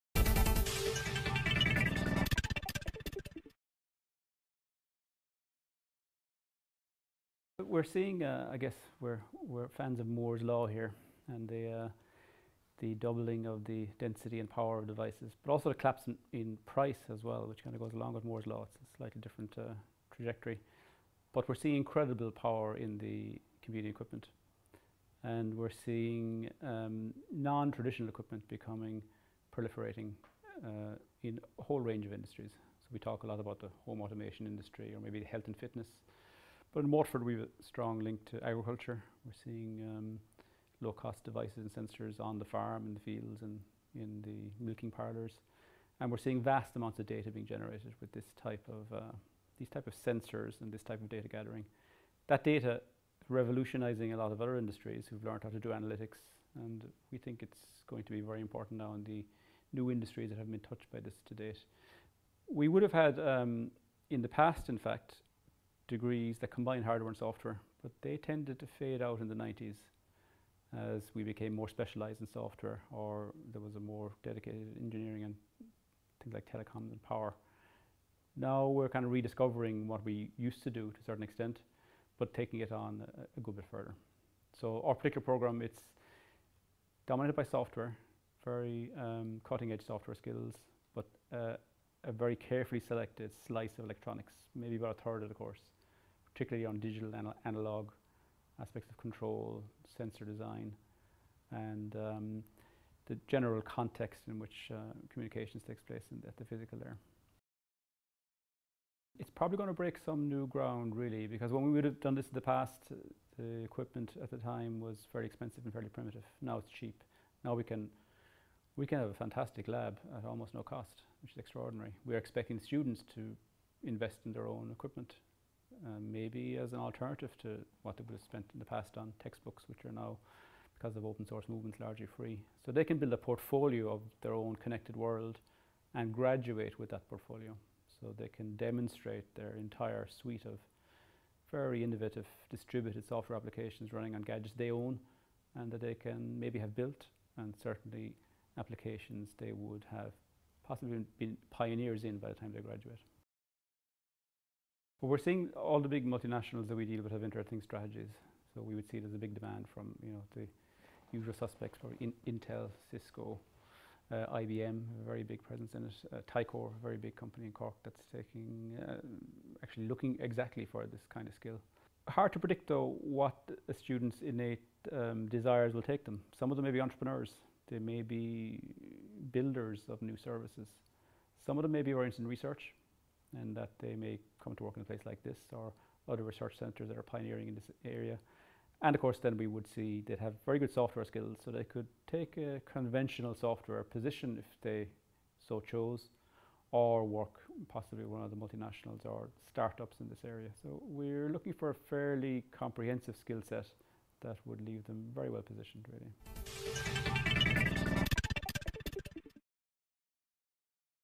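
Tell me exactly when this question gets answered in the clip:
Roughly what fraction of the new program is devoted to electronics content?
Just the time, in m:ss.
1:34.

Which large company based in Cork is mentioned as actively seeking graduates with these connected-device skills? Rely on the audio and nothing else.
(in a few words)
Tyco.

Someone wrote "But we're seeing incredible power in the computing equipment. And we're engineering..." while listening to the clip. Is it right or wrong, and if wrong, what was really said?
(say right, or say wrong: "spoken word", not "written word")
wrong: "seeing", not "engineering".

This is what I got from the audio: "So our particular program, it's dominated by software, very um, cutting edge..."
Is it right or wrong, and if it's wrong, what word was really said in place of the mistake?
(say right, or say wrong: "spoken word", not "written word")
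right.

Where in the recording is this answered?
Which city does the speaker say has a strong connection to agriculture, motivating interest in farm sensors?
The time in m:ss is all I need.
0:36.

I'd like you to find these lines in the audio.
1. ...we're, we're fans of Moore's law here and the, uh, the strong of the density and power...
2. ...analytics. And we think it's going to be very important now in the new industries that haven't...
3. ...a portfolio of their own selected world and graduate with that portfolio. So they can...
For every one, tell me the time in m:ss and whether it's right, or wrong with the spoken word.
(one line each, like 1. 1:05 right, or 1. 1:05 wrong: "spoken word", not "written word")
1. 0:08 wrong: "doubling", not "strong"
2. 0:55 right
3. 2:13 wrong: "connected", not "selected".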